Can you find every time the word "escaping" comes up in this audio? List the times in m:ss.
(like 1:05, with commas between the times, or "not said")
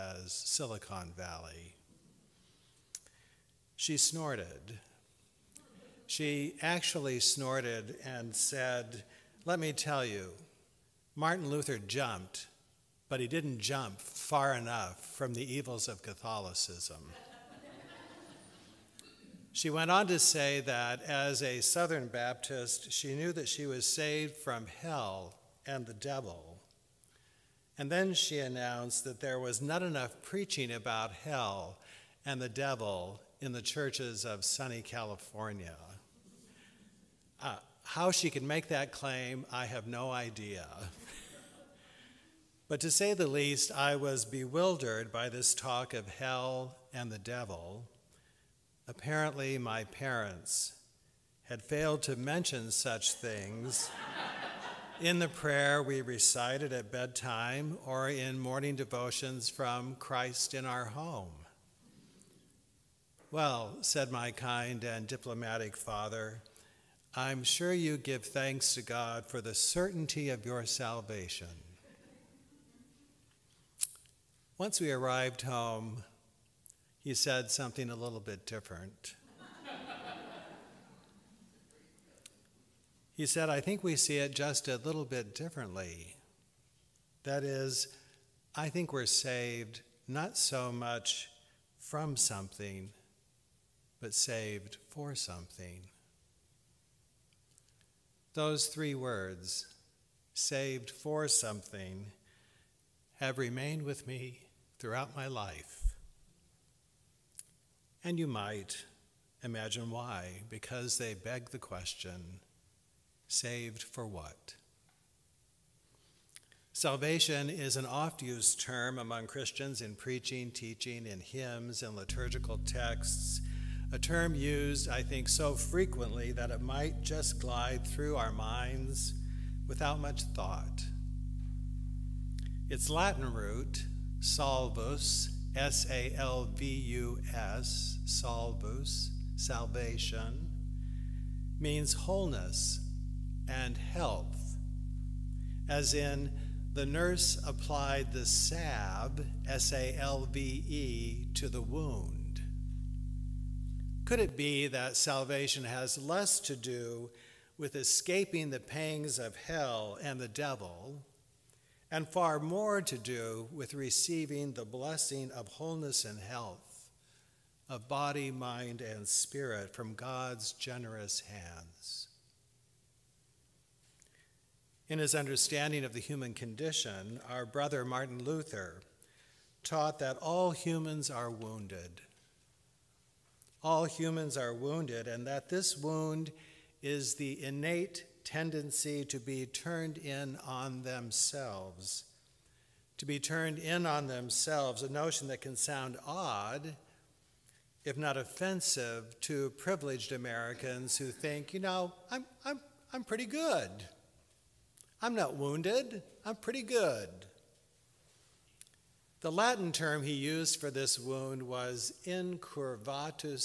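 2:37.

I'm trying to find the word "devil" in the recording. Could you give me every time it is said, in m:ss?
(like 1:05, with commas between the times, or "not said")
0:25, 0:32, 0:47, 2:40.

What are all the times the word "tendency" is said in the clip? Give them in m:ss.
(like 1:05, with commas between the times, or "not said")
3:08.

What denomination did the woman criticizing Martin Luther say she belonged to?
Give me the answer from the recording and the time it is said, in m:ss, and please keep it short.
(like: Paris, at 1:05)
Southern Baptist, at 0:21.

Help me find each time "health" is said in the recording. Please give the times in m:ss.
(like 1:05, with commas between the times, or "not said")
2:23, 2:46.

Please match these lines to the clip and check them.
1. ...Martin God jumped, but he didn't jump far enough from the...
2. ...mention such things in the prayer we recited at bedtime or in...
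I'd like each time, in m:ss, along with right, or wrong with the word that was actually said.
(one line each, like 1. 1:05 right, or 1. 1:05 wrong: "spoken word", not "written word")
1. 0:11 wrong: "Luther", not "God"
2. 0:52 right.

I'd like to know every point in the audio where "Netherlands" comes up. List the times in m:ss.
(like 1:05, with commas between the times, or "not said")
not said.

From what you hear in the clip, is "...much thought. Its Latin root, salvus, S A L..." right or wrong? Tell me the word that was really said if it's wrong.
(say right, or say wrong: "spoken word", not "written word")
right.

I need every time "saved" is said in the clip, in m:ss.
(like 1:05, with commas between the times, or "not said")
0:23, 1:29, 1:34, 1:40, 1:53.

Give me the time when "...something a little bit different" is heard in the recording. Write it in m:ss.
1:17.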